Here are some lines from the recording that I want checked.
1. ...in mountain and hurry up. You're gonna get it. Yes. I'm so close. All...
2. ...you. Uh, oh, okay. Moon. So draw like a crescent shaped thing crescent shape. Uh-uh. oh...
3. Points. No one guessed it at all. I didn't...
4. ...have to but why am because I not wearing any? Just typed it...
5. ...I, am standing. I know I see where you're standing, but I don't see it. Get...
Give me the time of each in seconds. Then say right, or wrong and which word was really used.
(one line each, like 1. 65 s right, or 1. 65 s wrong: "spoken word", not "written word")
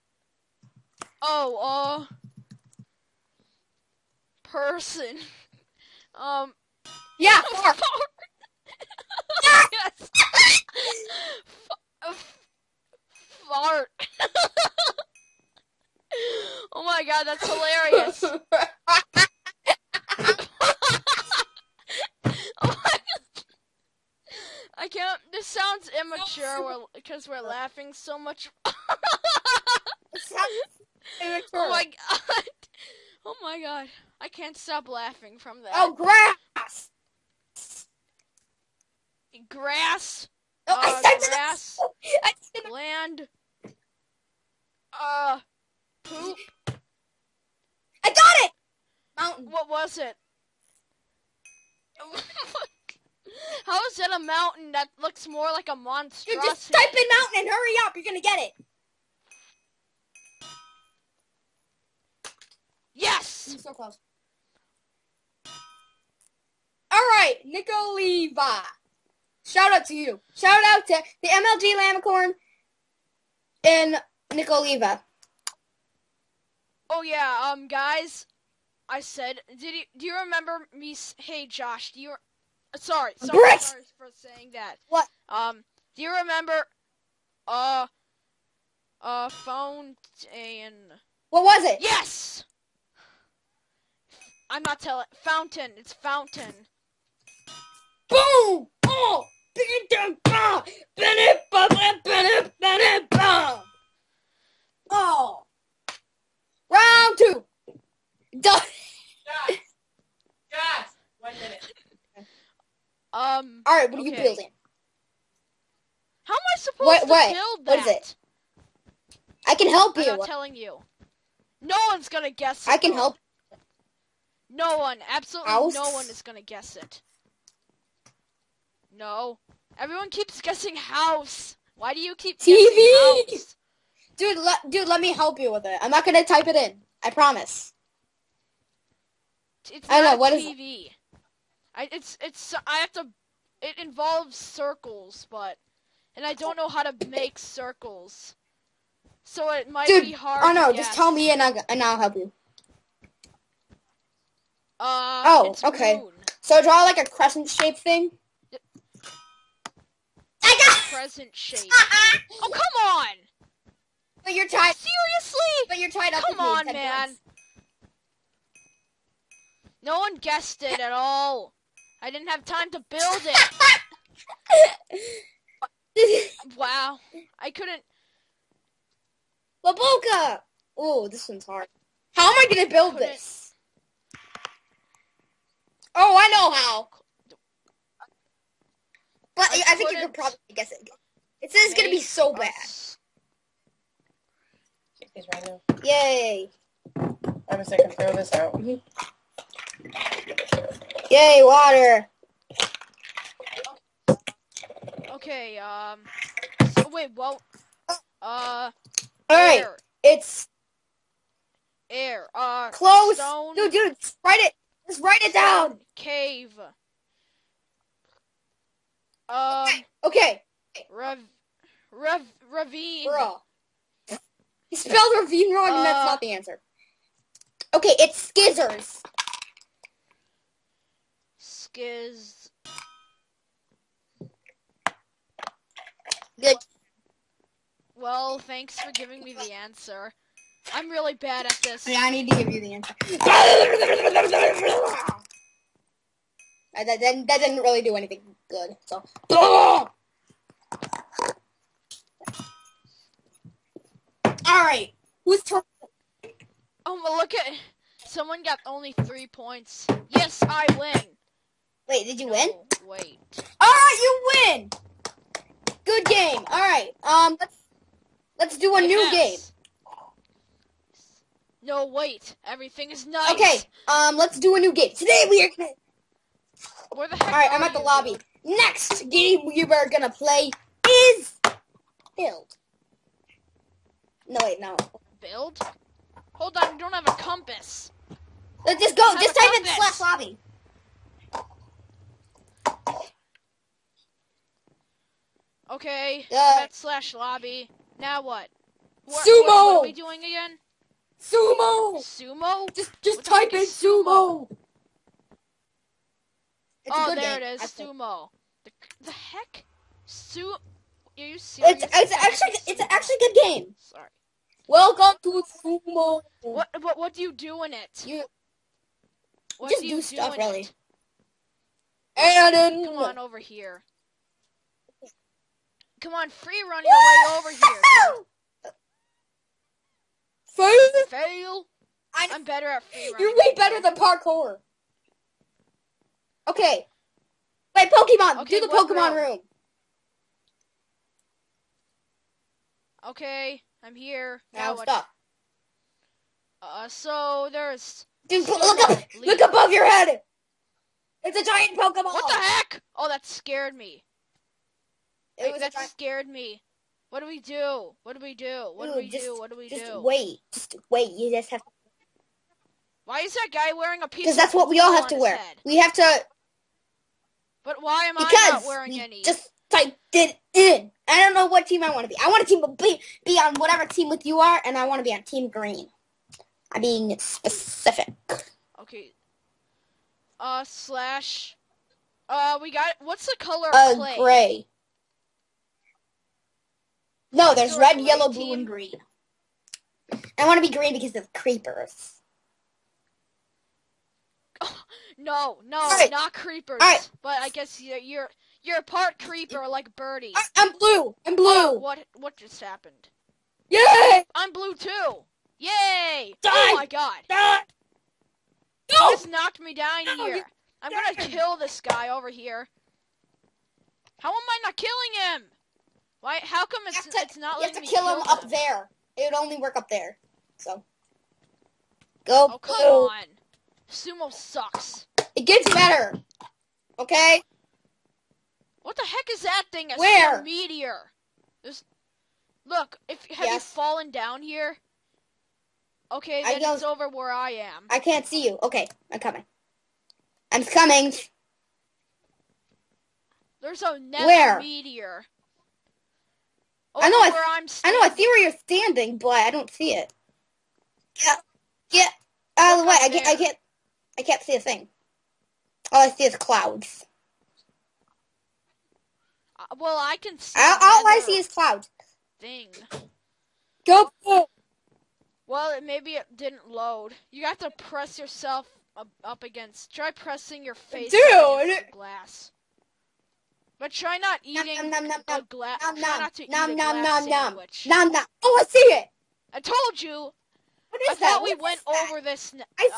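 1. 56 s right
2. 152 s wrong: "present", not "crescent"
3. 167 s right
4. 365 s right
5. 447 s right.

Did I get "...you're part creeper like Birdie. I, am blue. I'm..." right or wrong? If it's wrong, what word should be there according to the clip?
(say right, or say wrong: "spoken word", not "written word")
right.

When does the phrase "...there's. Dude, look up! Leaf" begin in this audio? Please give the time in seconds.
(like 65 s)
347 s.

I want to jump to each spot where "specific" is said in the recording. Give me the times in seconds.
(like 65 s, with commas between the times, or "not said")
377 s.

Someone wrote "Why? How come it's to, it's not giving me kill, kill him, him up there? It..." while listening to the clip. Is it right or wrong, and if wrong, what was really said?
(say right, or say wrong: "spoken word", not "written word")
wrong: "letting", not "giving".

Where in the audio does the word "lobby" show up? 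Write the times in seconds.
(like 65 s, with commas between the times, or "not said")
277 s, 290 s, 297 s.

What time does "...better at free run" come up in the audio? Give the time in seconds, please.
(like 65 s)
332 s.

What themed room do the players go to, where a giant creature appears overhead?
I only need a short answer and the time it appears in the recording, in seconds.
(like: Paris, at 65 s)
Pokemon room, at 338 s.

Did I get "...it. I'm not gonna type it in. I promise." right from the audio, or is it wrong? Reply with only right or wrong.
right.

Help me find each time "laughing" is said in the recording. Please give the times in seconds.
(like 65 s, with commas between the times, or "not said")
27 s, 34 s.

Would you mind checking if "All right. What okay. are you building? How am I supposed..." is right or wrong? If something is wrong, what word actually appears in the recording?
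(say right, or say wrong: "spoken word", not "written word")
right.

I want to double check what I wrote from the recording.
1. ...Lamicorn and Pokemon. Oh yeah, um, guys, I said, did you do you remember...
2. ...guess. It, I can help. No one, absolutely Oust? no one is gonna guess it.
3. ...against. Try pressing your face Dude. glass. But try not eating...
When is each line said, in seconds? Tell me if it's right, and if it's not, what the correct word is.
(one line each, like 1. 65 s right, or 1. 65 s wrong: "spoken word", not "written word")
1. 71 s wrong: "Nikoliva", not "Pokemon"
2. 122 s right
3. 469 s right.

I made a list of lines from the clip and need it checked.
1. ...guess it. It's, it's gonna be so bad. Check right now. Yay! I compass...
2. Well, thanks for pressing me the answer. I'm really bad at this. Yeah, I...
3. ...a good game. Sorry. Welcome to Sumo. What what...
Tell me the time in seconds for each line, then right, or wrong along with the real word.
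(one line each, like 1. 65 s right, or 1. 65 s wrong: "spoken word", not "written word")
1. 190 s wrong: "guess", not "compass"
2. 237 s wrong: "giving", not "pressing"
3. 313 s right.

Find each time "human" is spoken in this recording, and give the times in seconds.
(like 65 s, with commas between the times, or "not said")
not said.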